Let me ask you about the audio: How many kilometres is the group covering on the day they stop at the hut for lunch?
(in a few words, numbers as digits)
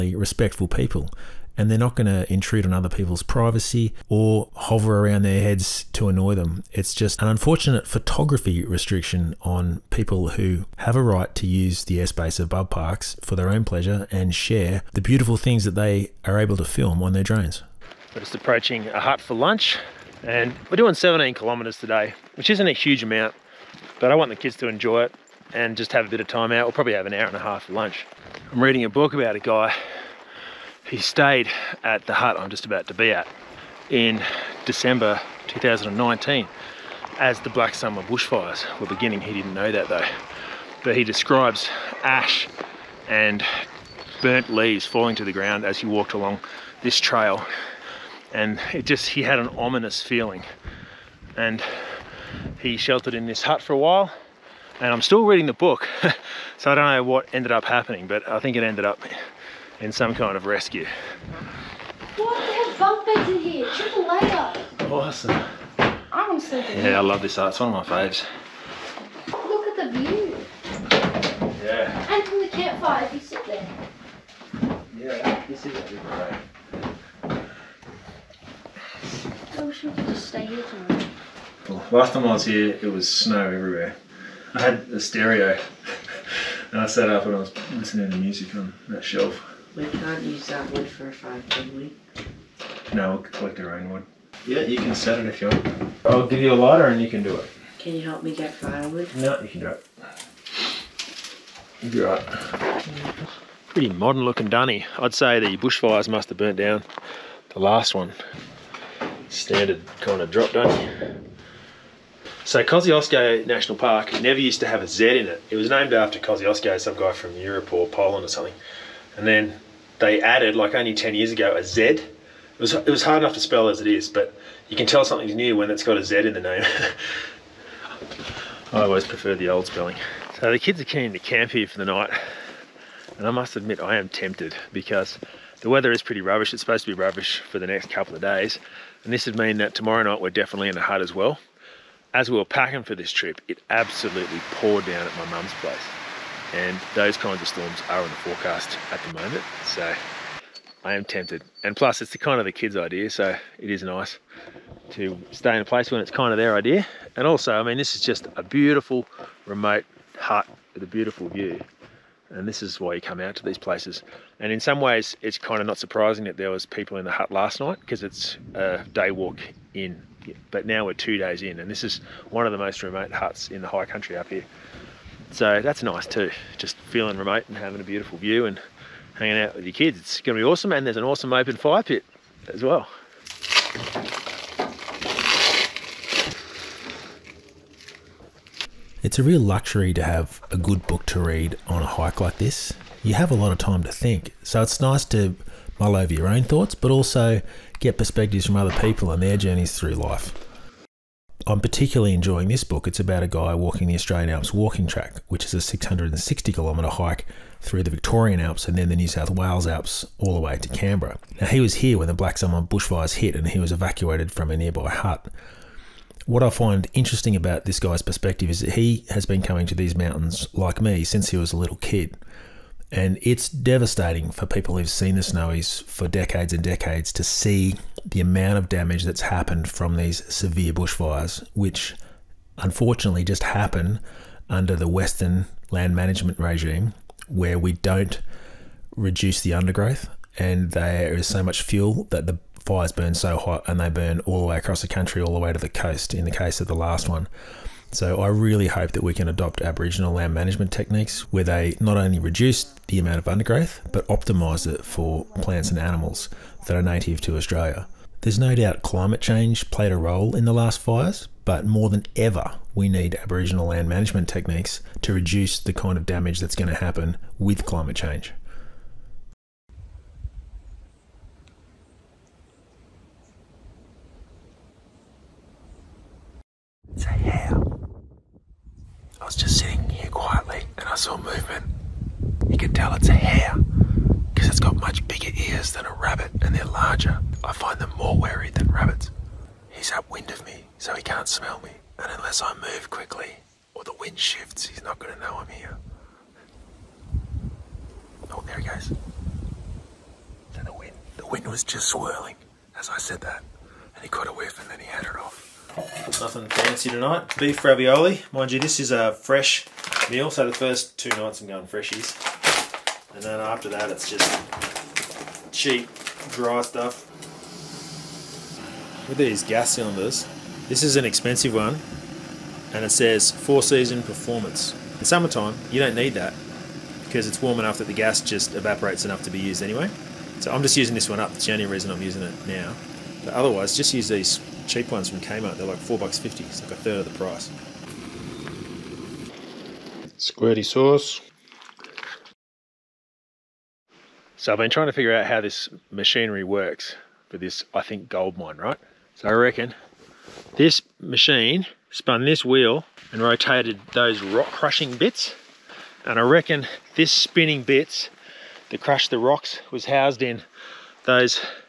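17.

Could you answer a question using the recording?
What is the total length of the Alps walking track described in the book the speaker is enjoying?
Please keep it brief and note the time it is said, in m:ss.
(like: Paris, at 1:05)
660 kilometres, at 3:25.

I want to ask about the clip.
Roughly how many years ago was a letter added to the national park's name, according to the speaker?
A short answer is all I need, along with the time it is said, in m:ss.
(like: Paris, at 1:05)
10, at 2:00.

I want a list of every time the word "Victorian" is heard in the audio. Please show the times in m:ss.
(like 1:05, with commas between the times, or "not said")
3:27.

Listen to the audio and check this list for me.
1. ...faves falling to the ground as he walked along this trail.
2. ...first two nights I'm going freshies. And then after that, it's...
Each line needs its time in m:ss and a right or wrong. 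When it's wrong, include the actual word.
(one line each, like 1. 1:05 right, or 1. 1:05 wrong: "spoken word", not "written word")
1. 0:44 wrong: "leaves", not "faves"
2. 5:10 right.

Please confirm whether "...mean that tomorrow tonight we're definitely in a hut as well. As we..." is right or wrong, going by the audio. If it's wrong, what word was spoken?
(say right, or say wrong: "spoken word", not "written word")
wrong: "night", not "tonight".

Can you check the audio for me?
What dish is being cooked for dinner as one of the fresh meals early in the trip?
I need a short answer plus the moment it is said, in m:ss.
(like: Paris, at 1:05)
Beef ravioli, at 5:07.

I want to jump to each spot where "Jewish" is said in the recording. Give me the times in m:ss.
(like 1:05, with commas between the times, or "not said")
not said.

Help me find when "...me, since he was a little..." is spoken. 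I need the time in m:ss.
3:40.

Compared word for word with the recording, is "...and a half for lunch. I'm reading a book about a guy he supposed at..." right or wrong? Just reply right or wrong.
wrong.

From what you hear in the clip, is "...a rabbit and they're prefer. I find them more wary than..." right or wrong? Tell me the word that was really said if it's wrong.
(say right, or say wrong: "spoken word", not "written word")
wrong: "larger", not "prefer".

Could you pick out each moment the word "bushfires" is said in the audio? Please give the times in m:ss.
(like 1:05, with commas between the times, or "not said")
0:38, 1:45, 3:32, 3:50.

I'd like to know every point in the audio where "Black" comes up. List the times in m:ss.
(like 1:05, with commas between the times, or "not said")
0:37, 3:32.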